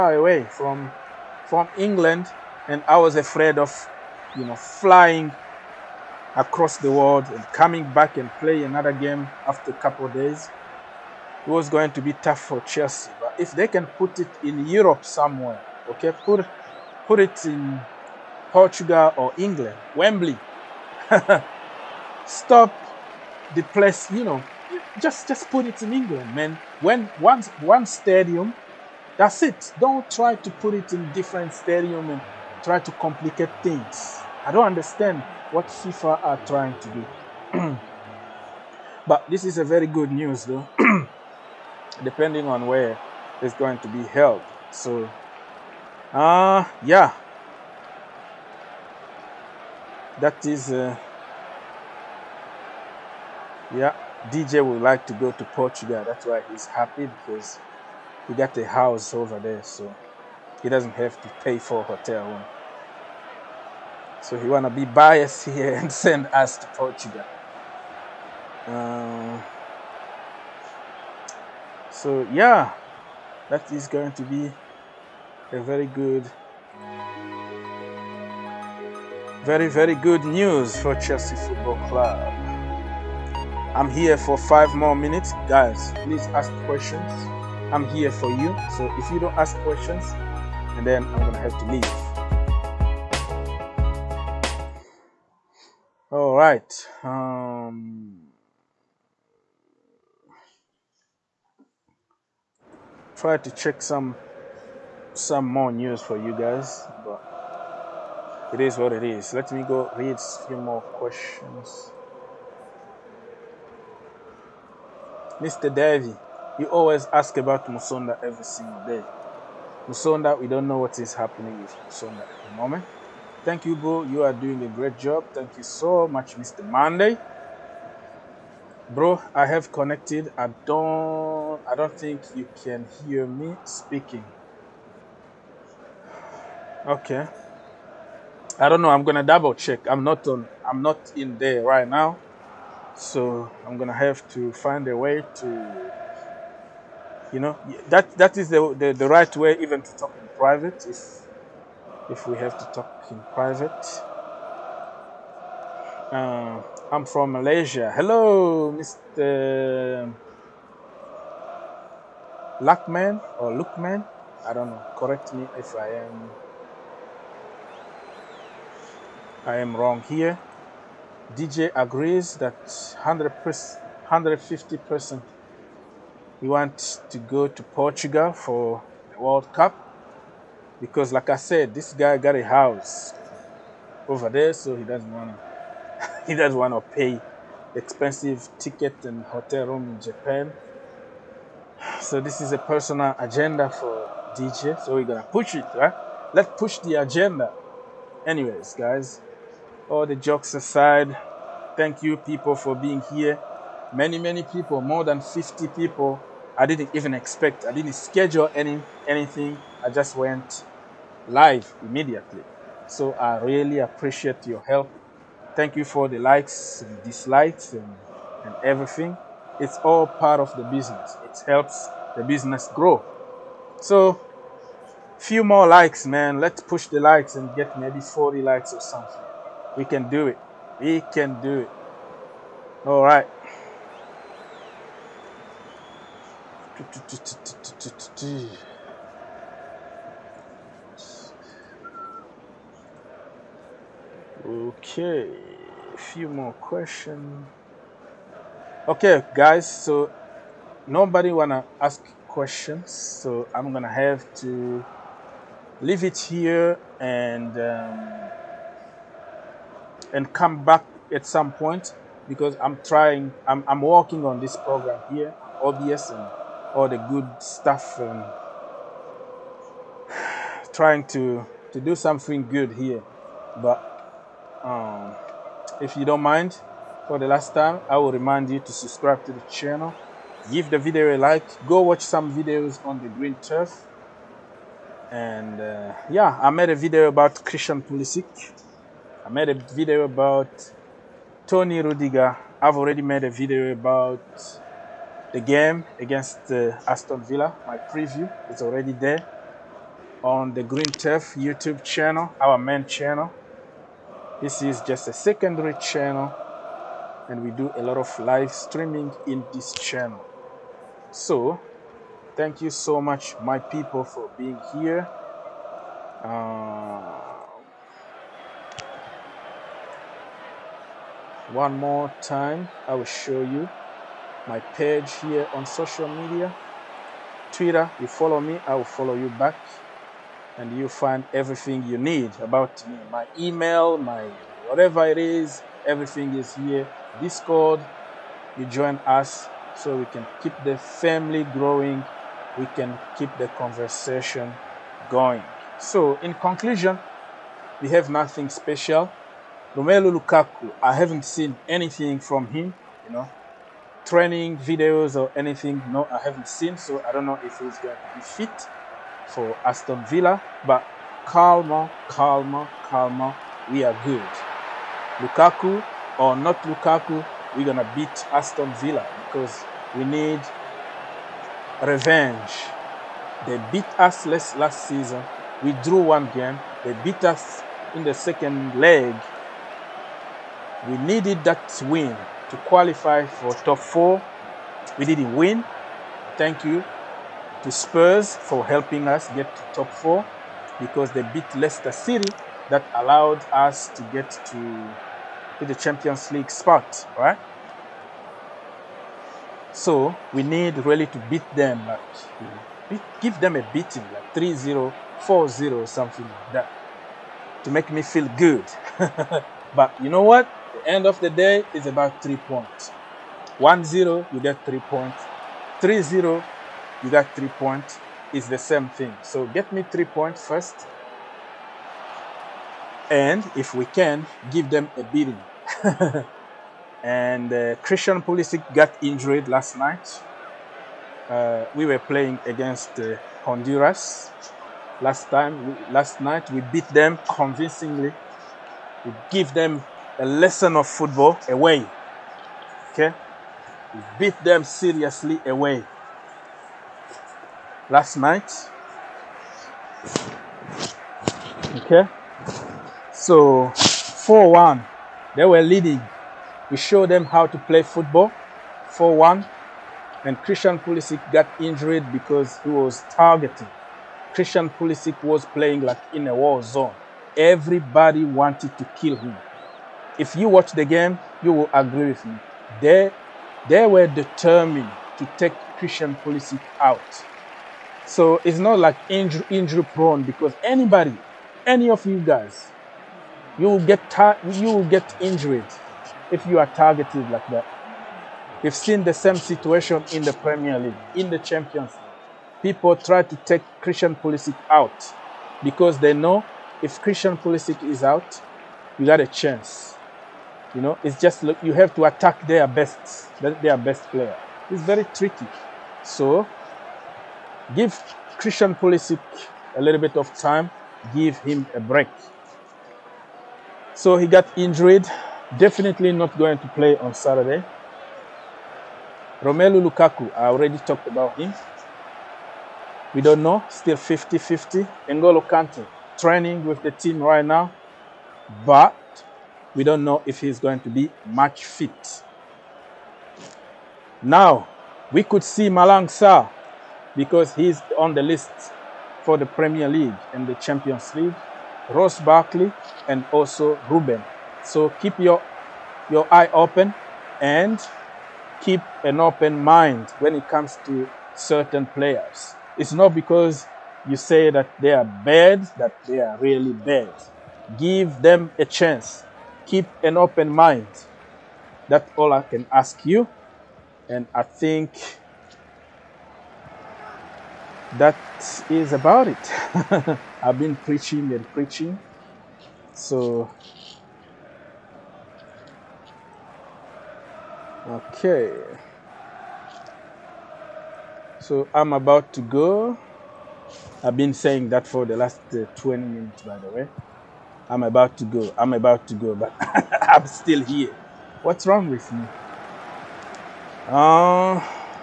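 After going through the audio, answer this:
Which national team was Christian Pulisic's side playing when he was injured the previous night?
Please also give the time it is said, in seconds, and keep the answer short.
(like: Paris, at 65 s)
Honduras, at 433 s.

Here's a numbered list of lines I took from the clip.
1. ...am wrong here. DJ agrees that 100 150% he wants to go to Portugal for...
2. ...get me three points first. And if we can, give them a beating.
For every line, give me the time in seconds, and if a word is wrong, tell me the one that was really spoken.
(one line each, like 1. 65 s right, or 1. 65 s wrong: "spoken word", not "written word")
1. 169 s right
2. 419 s right.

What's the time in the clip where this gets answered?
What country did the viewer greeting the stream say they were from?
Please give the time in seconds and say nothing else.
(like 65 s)
157 s.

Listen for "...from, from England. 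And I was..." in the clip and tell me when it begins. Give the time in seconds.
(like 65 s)
0 s.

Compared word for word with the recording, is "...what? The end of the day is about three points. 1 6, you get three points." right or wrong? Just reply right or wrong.
wrong.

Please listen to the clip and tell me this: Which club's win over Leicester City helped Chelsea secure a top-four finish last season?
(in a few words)
Spurs.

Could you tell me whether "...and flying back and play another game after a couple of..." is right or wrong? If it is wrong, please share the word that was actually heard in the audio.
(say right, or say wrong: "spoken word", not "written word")
wrong: "coming", not "flying".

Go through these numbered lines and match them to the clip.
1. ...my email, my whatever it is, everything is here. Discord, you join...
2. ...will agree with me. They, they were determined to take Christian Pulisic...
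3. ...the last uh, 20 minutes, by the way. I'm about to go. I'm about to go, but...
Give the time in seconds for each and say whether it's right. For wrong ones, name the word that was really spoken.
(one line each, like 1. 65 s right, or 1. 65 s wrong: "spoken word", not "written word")
1. 333 s right
2. 471 s right
3. 585 s right.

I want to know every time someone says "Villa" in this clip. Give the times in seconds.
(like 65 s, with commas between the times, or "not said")
297 s, 360 s, 368 s.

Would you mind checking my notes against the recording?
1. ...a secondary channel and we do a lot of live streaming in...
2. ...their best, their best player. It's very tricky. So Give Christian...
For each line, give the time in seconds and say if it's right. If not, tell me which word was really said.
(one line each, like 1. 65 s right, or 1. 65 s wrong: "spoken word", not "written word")
1. 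305 s right
2. 502 s right.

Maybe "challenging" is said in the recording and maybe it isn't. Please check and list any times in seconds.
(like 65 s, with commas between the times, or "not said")
not said.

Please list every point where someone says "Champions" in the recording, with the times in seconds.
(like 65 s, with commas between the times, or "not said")
395 s, 491 s, 540 s.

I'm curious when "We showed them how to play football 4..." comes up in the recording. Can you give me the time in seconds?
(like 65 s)
456 s.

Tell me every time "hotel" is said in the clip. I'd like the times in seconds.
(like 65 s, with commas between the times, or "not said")
61 s, 189 s.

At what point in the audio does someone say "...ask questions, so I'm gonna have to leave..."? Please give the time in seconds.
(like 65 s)
251 s.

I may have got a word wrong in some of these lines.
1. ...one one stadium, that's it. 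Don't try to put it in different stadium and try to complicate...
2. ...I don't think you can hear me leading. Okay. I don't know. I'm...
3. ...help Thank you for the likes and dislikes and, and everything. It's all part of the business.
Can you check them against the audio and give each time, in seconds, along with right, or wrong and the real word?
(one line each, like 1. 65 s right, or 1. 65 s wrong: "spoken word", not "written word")
1. 27 s right
2. 131 s wrong: "speaking", not "leading"
3. 214 s right.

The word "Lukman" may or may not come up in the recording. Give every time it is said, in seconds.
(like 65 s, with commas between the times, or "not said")
163 s.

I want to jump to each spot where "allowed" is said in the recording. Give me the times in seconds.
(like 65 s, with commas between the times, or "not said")
392 s.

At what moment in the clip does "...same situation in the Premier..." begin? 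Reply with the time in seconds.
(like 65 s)
489 s.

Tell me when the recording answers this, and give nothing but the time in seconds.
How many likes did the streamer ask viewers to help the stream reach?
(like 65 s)
227 s.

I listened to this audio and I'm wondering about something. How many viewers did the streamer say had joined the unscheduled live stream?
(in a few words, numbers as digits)
more than 50.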